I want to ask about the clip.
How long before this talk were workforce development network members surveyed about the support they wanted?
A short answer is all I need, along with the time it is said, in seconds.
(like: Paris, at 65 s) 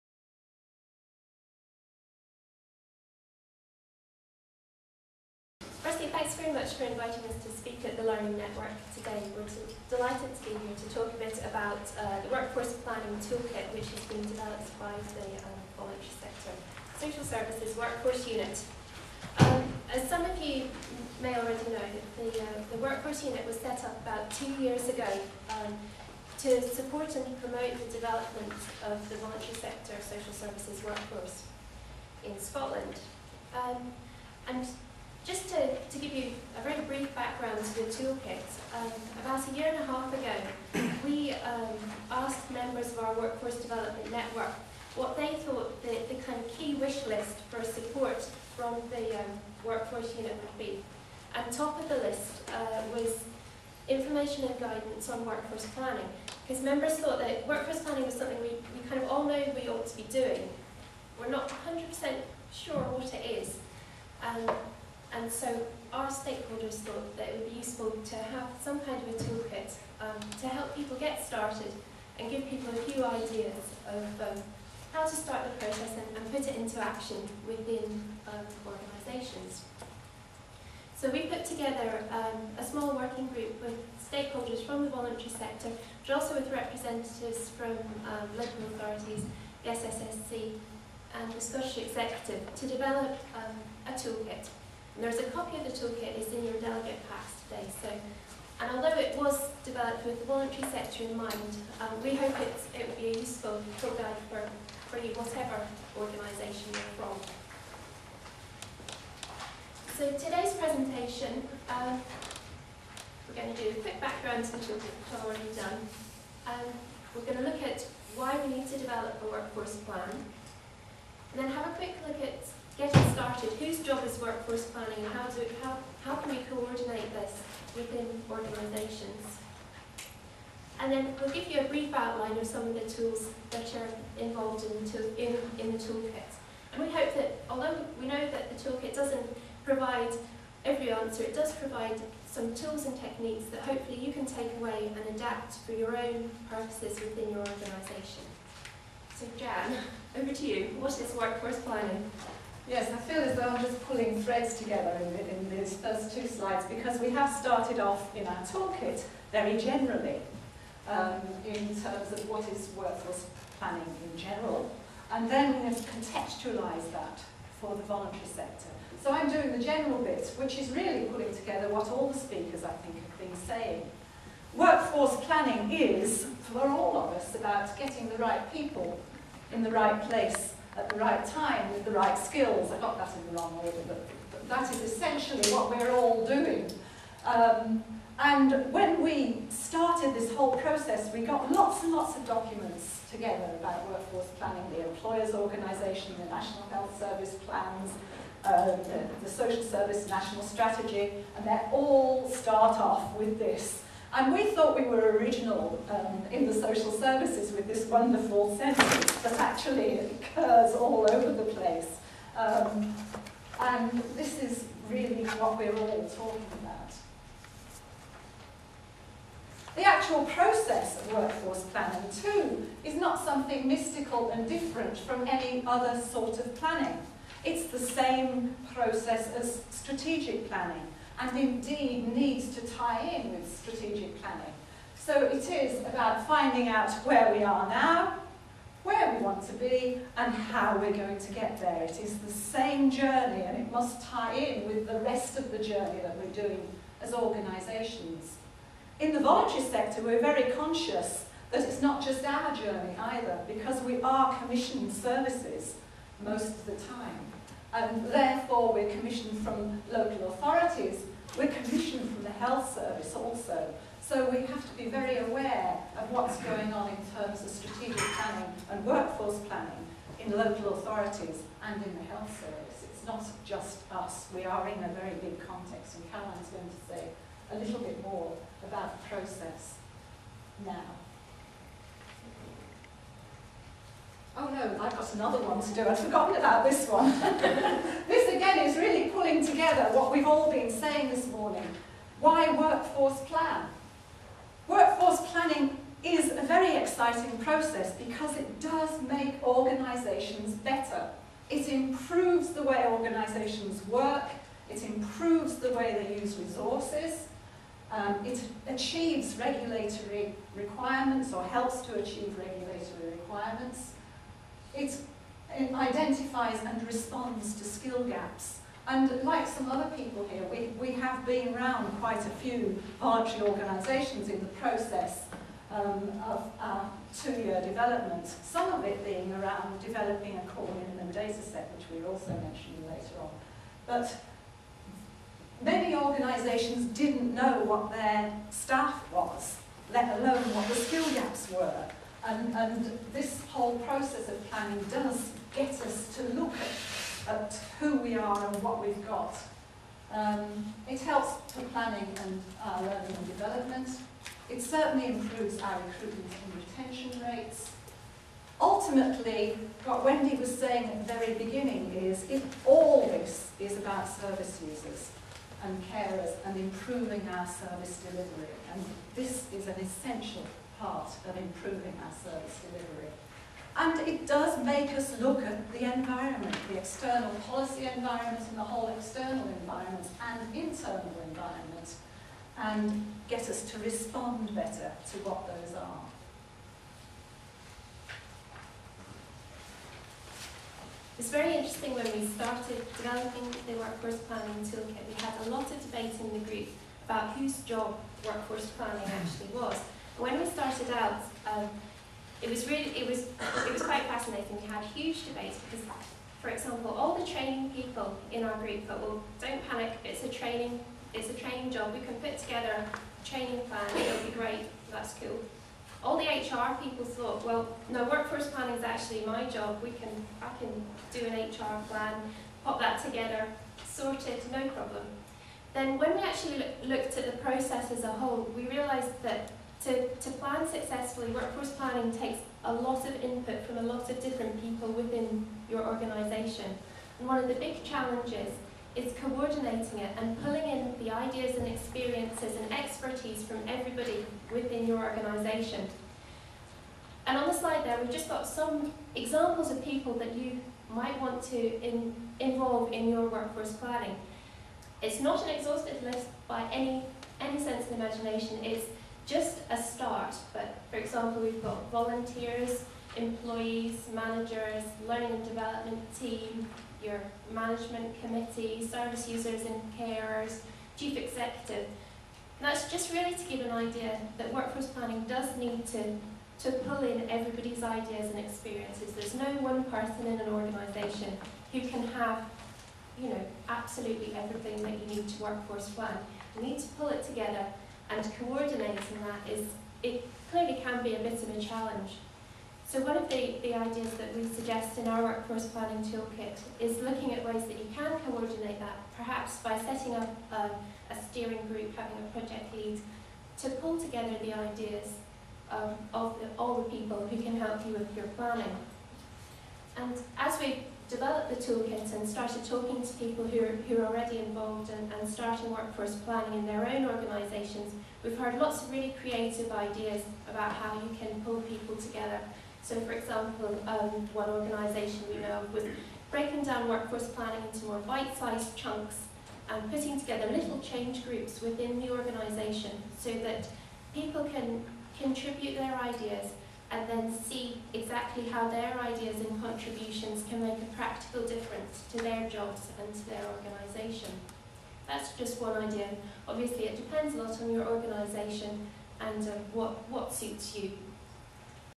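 a year and a half ago, at 39 s.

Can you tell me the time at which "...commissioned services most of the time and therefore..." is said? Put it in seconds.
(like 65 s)
254 s.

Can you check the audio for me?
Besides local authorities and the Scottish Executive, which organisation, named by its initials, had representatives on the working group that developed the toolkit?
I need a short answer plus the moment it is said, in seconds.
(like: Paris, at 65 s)
SSSC, at 89 s.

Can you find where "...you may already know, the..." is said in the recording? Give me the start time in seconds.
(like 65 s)
20 s.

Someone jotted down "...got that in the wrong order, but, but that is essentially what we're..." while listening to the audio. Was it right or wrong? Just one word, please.
right.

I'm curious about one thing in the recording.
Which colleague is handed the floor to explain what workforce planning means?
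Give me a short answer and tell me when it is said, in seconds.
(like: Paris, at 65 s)
Jan, at 149 s.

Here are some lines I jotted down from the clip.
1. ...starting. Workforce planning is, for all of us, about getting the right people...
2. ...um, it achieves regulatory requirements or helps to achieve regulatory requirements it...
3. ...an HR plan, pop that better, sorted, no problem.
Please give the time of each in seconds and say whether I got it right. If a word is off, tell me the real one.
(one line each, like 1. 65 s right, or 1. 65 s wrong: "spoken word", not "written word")
1. 173 s wrong: "saying", not "starting"
2. 307 s right
3. 421 s wrong: "together", not "better".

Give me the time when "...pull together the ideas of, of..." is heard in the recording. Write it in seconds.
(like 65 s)
503 s.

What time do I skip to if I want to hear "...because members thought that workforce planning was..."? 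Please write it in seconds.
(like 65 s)
56 s.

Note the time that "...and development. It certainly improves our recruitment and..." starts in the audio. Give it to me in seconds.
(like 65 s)
353 s.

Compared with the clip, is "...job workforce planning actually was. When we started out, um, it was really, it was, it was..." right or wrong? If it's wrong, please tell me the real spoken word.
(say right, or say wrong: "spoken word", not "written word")
right.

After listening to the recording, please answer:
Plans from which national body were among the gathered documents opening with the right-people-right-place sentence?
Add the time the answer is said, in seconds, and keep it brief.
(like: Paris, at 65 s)
National Health Service, at 196 s.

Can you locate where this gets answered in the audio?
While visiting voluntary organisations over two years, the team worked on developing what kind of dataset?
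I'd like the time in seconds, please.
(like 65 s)
330 s.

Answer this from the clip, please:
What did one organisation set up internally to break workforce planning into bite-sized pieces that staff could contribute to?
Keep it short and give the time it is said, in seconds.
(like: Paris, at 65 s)
change groups, at 530 s.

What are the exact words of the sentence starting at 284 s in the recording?
oh no, I've got another one to do, I'd forgotten about this one.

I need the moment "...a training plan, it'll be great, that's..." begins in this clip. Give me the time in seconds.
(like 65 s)
412 s.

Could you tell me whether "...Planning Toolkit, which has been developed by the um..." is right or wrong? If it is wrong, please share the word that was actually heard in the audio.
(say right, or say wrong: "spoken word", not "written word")
right.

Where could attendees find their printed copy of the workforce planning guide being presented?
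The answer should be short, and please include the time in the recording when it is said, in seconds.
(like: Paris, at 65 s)
delegate packs, at 96 s.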